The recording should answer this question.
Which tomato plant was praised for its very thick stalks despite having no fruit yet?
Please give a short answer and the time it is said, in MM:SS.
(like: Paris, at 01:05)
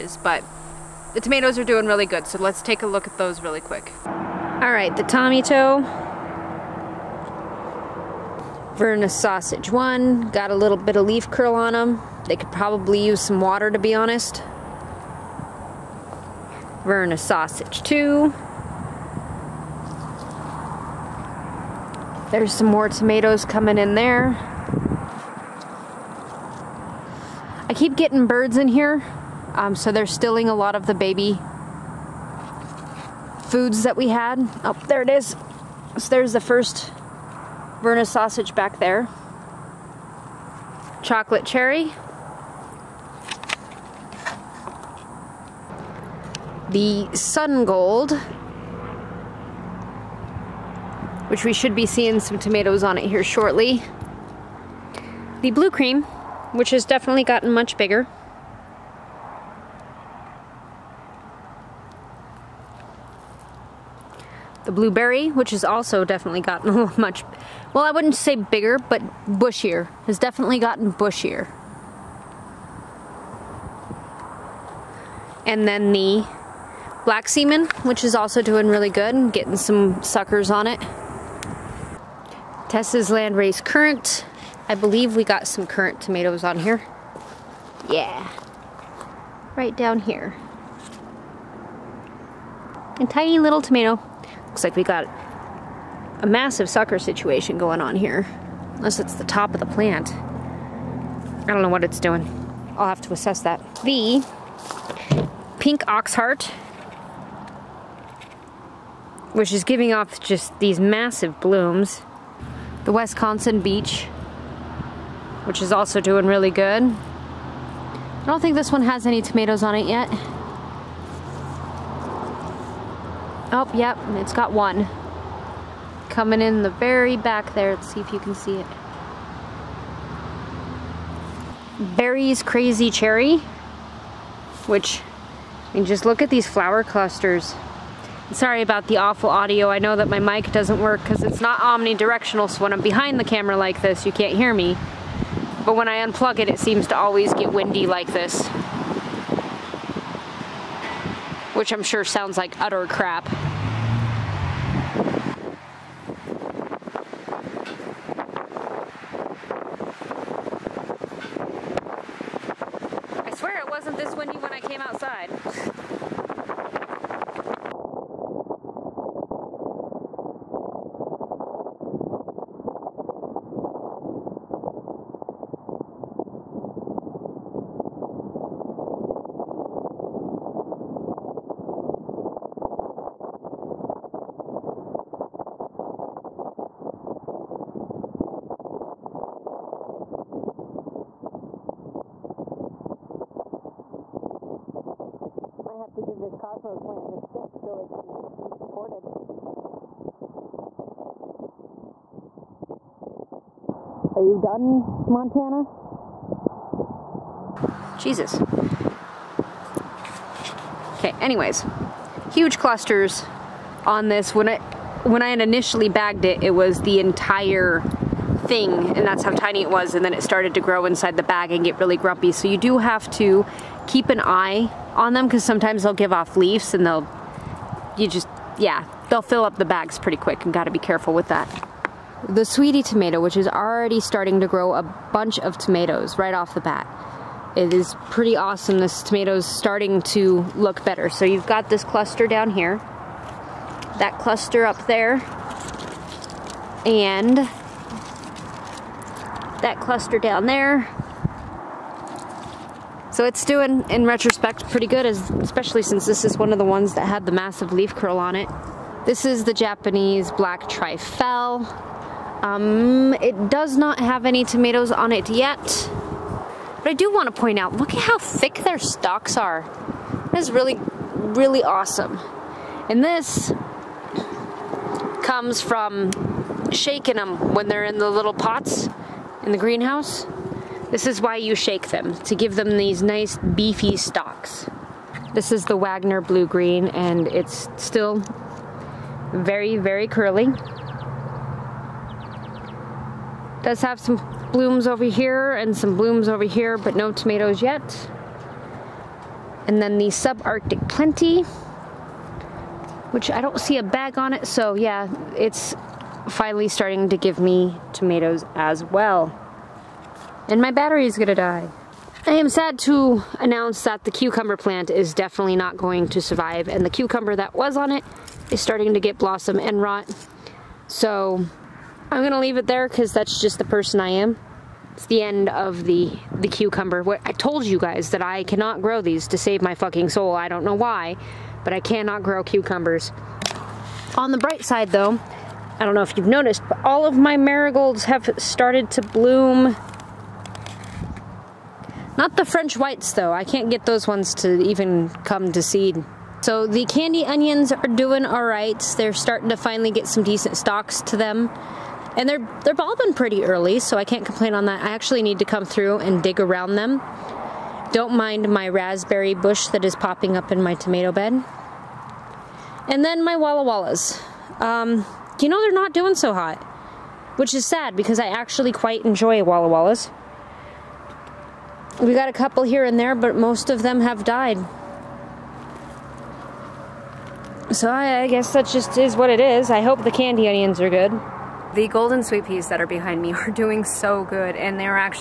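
Japanese Black Trifele, at 04:19.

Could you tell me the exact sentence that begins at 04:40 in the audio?
This is why you shake them, to give them these nice beefy stalks.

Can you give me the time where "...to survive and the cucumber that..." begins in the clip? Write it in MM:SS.
05:16.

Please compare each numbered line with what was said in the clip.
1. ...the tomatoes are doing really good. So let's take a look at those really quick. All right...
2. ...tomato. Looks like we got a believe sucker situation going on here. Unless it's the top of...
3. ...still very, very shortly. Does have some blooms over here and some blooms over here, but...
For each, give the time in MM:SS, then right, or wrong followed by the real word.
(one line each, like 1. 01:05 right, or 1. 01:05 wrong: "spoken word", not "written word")
1. 00:01 right
2. 01:33 wrong: "massive", not "believe"
3. 04:47 wrong: "curly", not "shortly".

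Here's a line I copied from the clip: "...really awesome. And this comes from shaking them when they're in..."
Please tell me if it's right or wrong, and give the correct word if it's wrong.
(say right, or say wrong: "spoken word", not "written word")
right.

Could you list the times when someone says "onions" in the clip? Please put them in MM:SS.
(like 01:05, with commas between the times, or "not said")
05:47, 06:20.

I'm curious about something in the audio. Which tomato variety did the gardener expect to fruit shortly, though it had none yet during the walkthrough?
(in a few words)
Sun gold.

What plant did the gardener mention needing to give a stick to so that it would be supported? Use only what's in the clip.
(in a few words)
Cosmos.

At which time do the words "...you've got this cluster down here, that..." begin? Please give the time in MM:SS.
04:01.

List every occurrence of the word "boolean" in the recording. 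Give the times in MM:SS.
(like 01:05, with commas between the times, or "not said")
not said.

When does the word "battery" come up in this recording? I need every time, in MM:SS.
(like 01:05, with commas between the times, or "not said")
05:10.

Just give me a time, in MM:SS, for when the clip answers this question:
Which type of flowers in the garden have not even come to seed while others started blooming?
05:42.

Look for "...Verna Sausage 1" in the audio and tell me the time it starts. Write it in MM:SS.
00:08.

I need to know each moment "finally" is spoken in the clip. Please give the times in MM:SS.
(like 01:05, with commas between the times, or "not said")
05:06, 05:49.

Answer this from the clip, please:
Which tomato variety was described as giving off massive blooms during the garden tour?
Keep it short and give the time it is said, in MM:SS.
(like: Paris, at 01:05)
Pink oxheart, at 01:43.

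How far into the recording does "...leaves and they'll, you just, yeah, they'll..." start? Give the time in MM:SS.
03:46.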